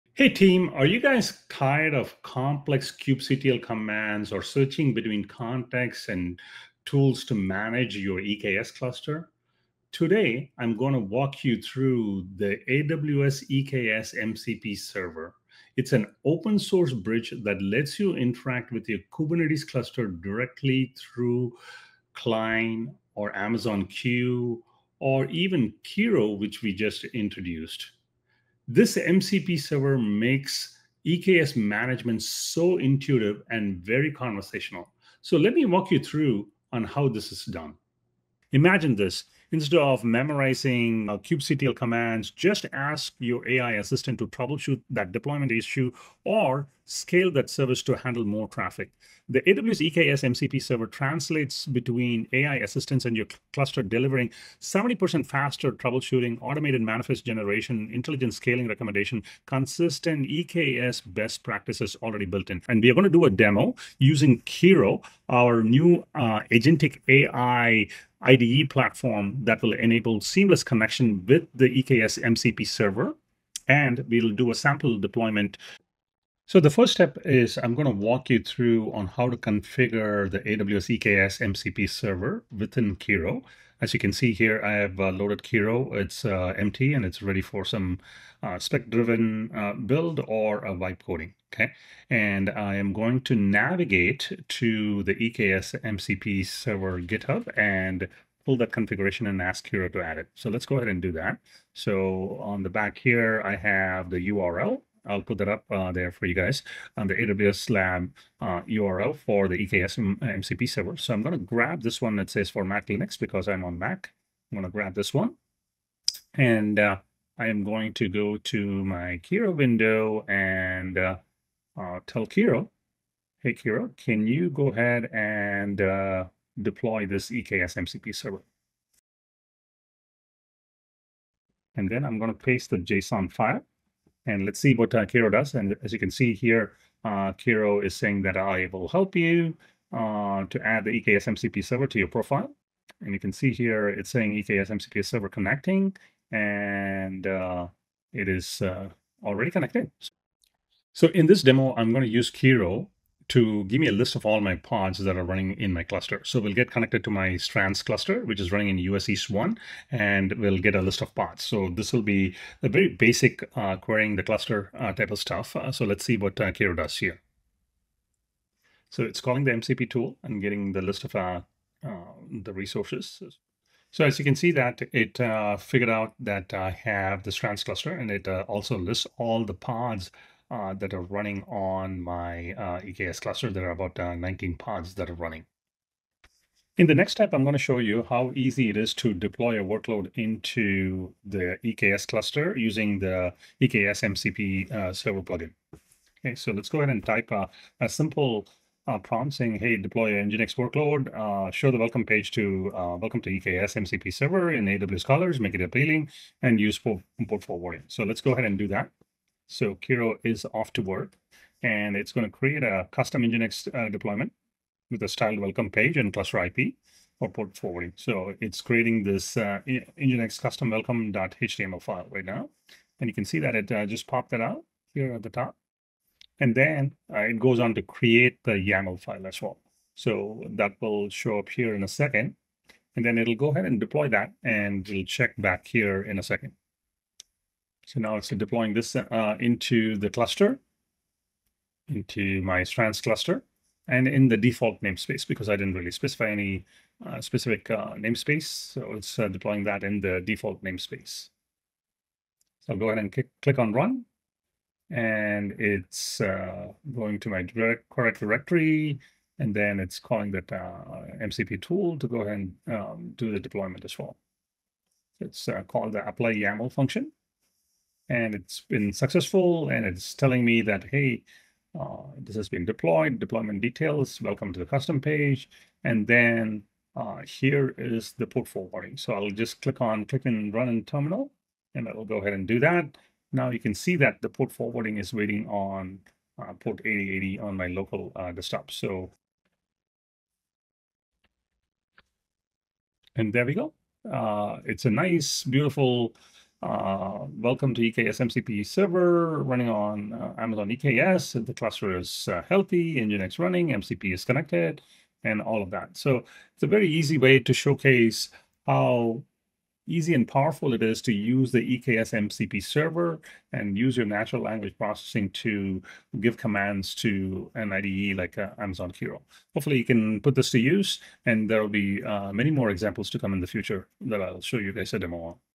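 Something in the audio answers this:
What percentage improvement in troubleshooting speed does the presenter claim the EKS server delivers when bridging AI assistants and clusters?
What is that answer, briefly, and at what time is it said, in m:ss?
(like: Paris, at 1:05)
70%, at 0:54.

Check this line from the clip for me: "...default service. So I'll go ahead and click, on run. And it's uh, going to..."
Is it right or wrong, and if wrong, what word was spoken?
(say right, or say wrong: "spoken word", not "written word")
wrong: "namespace", not "service".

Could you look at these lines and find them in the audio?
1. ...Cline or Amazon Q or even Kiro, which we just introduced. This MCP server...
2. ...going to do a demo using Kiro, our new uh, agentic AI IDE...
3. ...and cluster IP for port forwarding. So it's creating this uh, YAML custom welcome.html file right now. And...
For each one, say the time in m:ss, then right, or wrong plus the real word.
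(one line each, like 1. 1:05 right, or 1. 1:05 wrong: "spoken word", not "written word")
1. 0:22 right
2. 1:02 right
3. 3:35 wrong: "Nginx", not "YAML".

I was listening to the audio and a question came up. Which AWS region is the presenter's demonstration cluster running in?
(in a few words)
US East 1.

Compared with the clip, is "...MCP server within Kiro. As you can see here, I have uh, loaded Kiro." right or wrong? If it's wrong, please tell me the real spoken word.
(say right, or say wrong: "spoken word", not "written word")
right.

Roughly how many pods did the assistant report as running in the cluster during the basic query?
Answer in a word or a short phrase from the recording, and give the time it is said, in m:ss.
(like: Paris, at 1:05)
19, at 3:04.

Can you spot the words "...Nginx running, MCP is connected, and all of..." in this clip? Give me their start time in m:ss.
5:03.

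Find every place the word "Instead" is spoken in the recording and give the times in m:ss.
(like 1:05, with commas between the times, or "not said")
0:39.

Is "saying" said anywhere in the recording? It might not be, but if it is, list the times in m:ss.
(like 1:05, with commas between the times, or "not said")
2:17, 2:24, 3:19.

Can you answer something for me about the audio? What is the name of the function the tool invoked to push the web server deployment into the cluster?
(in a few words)
apply YAML.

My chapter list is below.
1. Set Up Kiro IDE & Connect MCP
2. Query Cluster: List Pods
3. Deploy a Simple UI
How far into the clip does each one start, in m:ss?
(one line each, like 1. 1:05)
1. 1:05
2. 2:36
3. 3:16.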